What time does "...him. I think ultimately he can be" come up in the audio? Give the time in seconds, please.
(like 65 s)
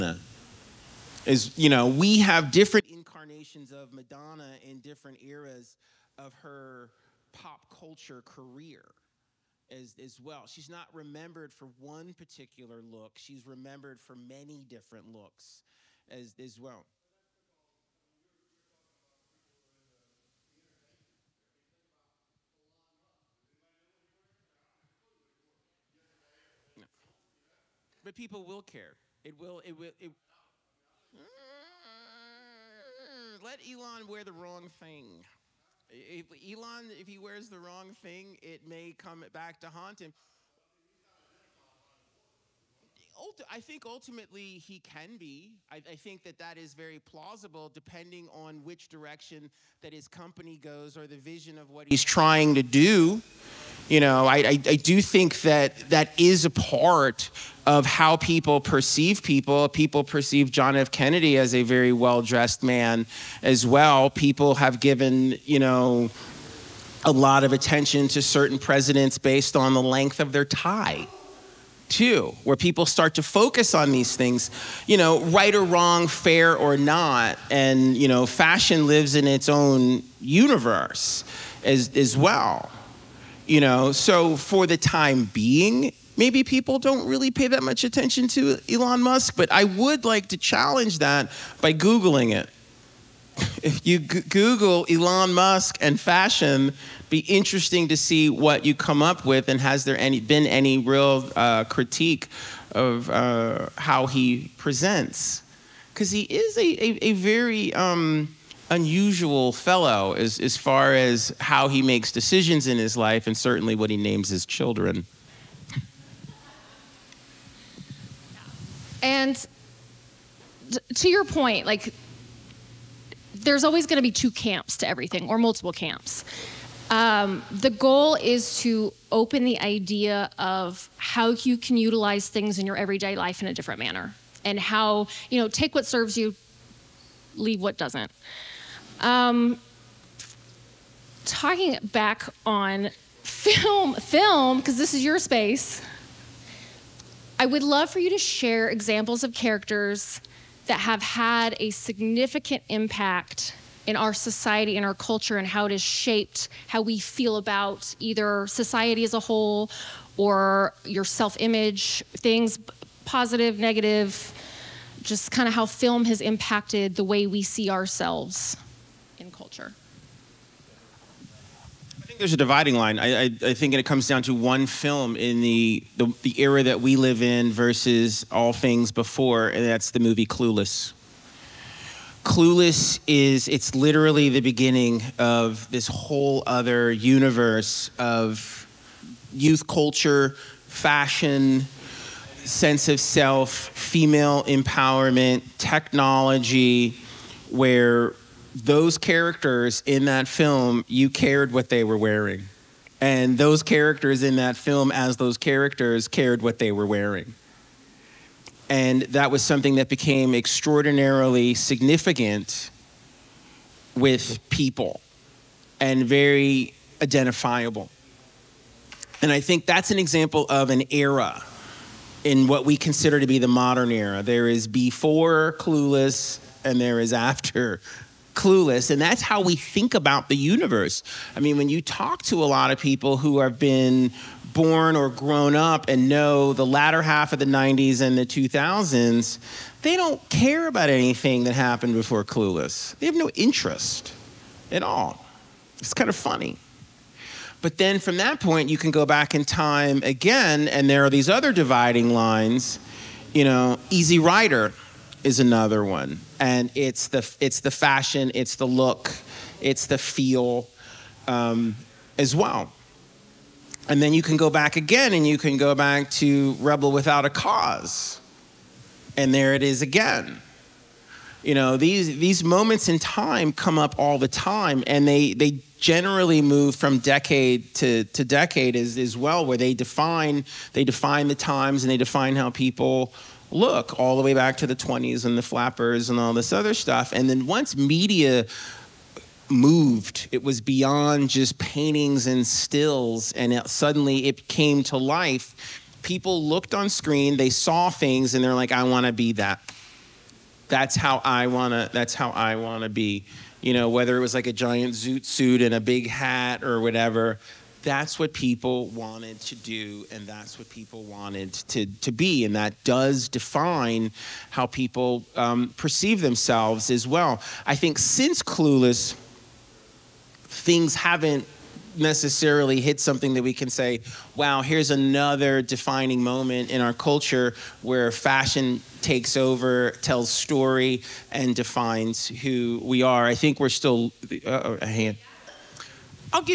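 40 s.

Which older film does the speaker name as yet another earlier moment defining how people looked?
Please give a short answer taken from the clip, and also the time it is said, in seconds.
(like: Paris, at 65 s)
Rebel Without a Cause, at 266 s.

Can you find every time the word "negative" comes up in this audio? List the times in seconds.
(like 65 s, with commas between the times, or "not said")
163 s.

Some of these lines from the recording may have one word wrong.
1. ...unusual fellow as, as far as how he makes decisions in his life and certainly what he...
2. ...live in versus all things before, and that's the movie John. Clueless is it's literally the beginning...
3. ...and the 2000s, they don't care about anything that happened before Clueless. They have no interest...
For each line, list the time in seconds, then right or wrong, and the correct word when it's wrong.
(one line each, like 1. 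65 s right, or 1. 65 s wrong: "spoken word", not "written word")
1. 108 s right
2. 176 s wrong: "Clueless", not "John"
3. 237 s right.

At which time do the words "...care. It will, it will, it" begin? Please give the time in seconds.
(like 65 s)
28 s.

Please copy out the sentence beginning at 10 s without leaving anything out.
She's not remembered for one particular look, she's remembered for many different looks as, as well.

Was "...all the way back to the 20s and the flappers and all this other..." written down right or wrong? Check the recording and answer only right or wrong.
right.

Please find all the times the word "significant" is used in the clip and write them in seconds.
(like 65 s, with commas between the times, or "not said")
151 s, 211 s.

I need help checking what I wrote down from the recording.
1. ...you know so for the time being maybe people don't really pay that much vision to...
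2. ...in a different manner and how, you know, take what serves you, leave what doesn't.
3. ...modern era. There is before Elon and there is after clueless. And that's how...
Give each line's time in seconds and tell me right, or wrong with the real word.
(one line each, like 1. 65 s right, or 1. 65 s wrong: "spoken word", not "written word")
1. 83 s wrong: "attention", not "vision"
2. 133 s right
3. 223 s wrong: "Clueless", not "Elon".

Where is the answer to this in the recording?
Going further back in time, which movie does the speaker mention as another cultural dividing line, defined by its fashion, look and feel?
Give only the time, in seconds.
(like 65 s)
253 s.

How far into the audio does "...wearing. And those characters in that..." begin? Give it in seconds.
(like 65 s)
201 s.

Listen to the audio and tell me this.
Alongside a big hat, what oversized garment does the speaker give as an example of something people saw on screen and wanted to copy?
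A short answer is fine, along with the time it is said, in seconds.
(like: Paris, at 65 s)
Zoot suit, at 304 s.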